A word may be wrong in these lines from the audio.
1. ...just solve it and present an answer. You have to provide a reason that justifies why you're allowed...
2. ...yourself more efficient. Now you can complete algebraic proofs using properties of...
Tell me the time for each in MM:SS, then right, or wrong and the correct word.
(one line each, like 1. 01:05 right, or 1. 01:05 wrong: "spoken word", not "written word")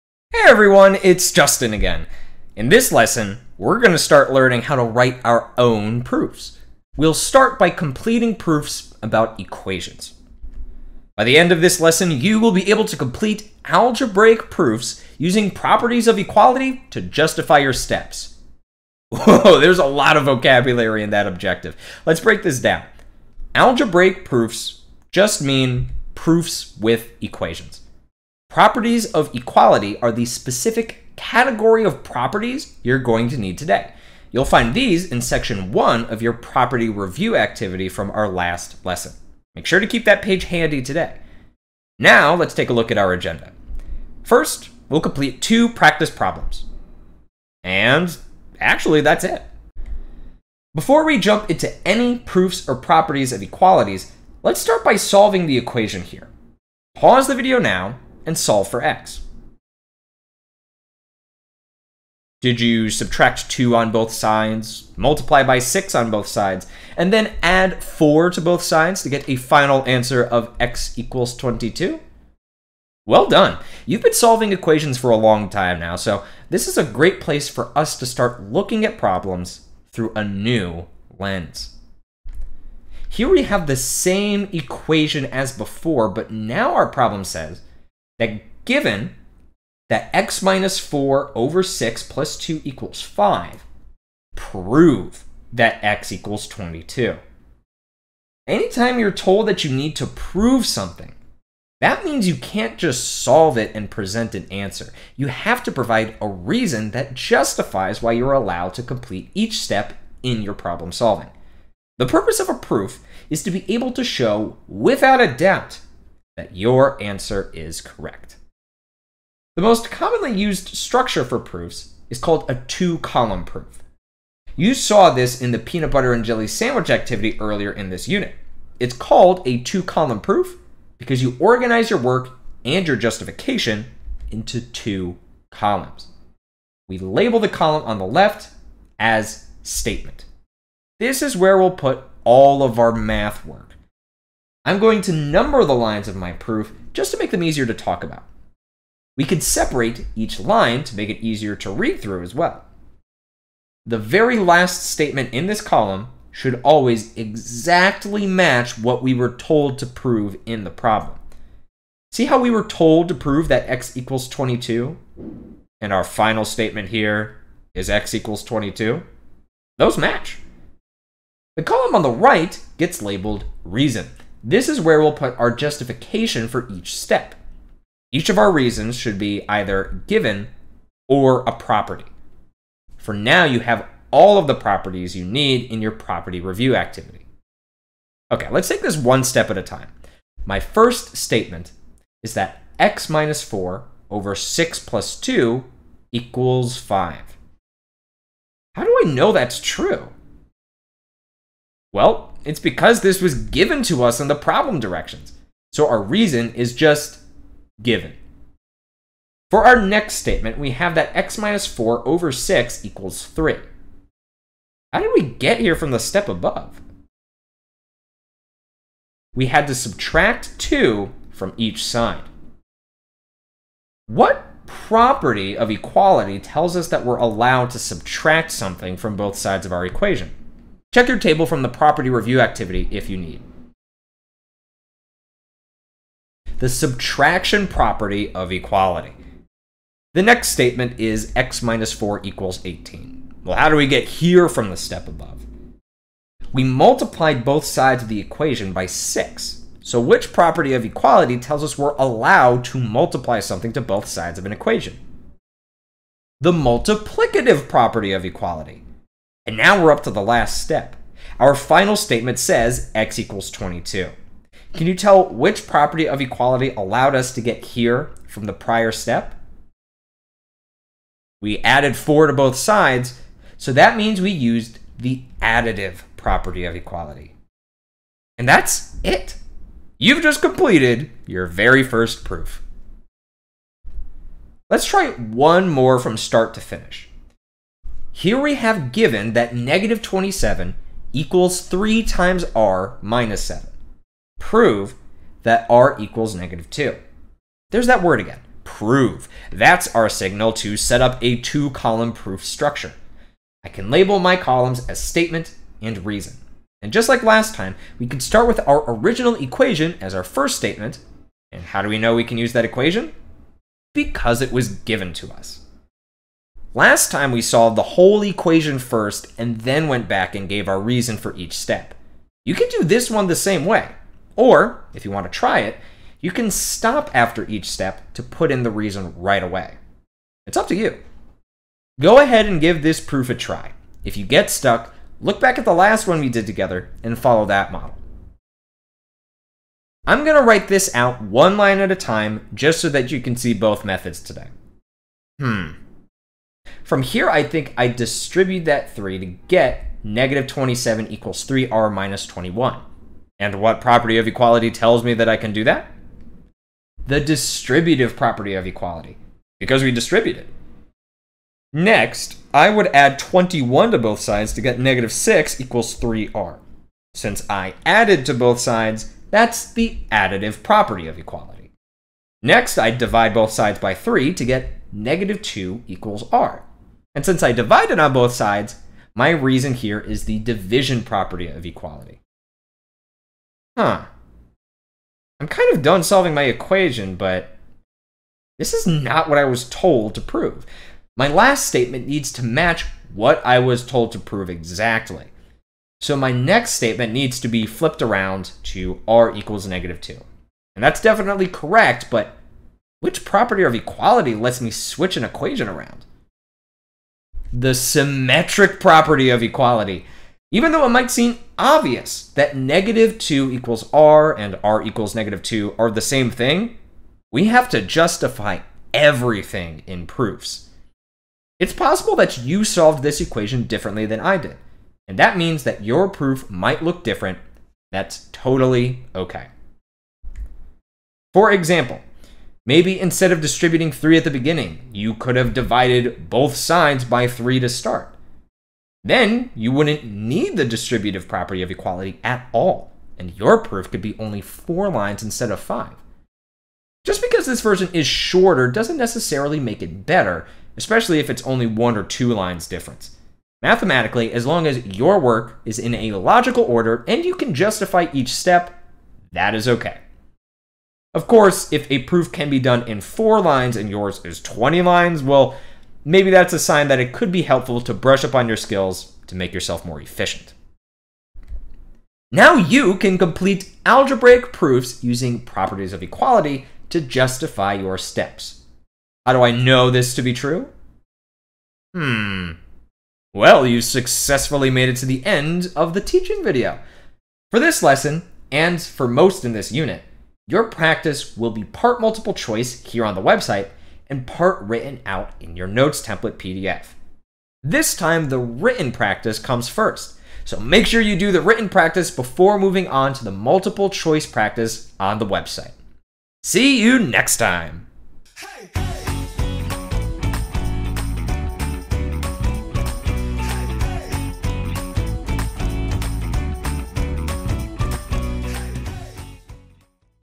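1. 01:42 right
2. 07:49 right.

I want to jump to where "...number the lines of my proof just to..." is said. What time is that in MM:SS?
02:25.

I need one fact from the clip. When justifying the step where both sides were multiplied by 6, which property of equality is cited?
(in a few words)
Multiplicative property of equality.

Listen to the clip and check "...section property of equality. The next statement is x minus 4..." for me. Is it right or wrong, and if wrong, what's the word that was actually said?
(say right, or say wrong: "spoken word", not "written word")
wrong: "subtraction", not "section".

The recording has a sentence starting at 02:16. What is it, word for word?
We label the column on the left as statement.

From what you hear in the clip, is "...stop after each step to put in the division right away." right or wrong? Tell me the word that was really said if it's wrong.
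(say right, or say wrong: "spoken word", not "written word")
wrong: "reason", not "division".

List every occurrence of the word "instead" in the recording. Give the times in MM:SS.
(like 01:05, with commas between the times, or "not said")
07:12, 07:25.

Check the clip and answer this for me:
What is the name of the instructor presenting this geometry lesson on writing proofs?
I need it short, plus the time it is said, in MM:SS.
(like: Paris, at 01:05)
Justin, at 00:01.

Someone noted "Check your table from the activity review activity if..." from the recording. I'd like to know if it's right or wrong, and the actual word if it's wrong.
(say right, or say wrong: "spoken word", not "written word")
wrong: "property", not "activity".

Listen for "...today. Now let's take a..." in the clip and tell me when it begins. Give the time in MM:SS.
00:40.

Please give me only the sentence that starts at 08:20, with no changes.
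So make sure you do the written practice before moving on to the multiple choice practice on the website.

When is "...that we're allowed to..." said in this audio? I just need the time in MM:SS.
03:46.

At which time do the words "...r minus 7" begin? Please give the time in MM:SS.
04:52.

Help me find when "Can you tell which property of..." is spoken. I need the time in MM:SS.
04:24.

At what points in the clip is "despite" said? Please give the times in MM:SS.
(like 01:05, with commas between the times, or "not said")
not said.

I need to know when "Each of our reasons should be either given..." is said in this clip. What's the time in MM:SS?
02:58.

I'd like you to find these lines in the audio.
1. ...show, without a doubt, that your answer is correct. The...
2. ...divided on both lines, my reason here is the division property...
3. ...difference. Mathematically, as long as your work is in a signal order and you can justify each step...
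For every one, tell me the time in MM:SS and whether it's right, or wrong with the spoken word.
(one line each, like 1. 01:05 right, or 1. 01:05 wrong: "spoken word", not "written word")
1. 01:54 right
2. 06:17 wrong: "sides", not "lines"
3. 07:32 wrong: "logical", not "signal".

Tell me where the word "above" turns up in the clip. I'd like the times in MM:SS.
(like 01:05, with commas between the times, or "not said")
03:36, 04:05.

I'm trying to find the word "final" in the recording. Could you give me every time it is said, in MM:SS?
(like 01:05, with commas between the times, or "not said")
01:09, 02:46, 04:21.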